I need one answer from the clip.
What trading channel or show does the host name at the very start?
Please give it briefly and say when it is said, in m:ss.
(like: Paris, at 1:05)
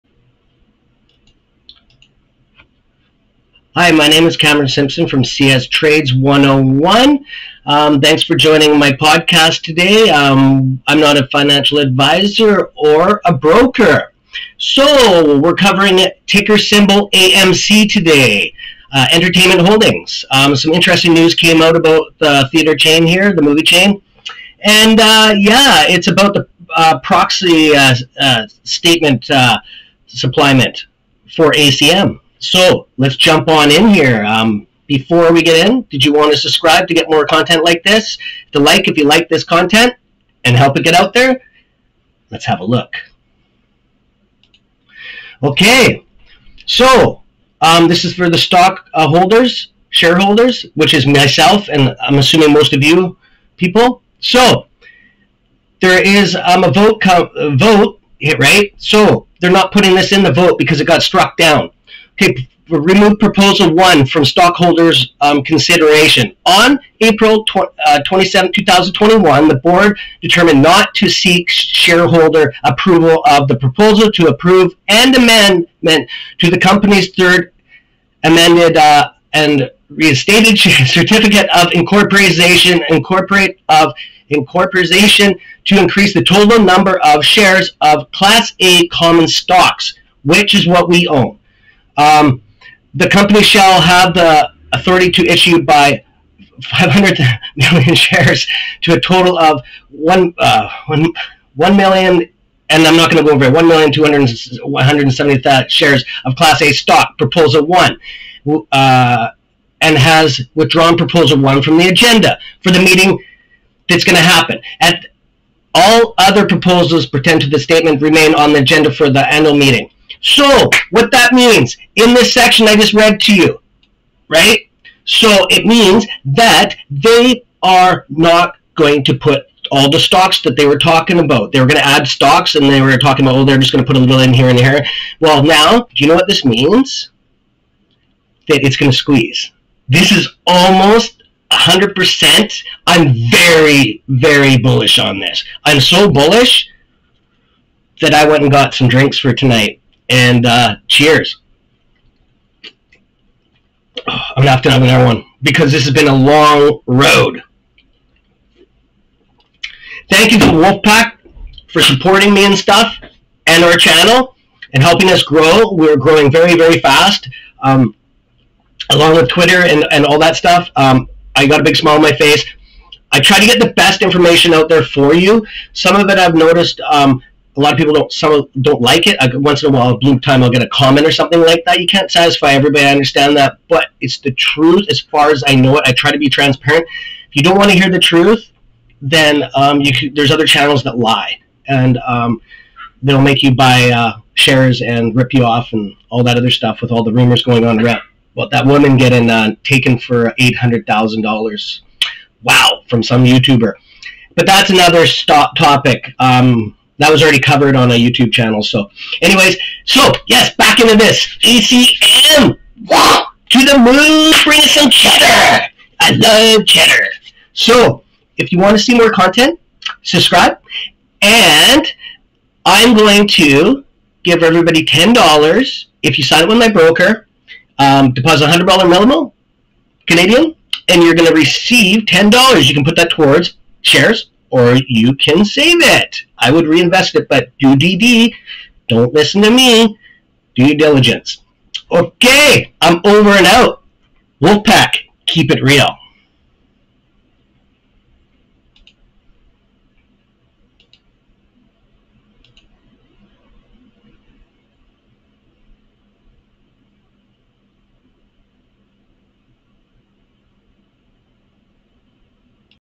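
CS Trades 101, at 0:05.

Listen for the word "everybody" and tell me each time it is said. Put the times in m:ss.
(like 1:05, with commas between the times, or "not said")
3:02, 3:44.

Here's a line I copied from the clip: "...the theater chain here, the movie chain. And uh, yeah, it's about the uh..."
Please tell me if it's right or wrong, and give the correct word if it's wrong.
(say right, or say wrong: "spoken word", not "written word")
right.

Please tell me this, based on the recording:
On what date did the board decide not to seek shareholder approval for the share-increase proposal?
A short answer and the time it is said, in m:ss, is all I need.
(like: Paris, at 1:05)
April 27, 2021, at 1:06.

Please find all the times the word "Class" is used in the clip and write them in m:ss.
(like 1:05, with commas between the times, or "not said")
1:28, 1:46.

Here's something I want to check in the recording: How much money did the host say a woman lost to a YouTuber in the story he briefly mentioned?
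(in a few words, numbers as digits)
$800,000.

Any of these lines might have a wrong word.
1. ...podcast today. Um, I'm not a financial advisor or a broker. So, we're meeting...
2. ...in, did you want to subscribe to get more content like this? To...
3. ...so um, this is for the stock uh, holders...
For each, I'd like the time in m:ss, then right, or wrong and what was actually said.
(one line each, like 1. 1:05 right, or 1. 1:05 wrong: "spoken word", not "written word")
1. 0:08 wrong: "covering", not "meeting"
2. 0:35 right
3. 0:46 right.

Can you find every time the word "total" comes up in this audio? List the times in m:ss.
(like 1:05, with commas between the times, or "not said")
1:26, 1:38.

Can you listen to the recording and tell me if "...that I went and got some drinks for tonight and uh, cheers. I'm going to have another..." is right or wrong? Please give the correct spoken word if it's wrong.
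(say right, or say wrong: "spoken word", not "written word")
right.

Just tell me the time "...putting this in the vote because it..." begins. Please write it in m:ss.
0:59.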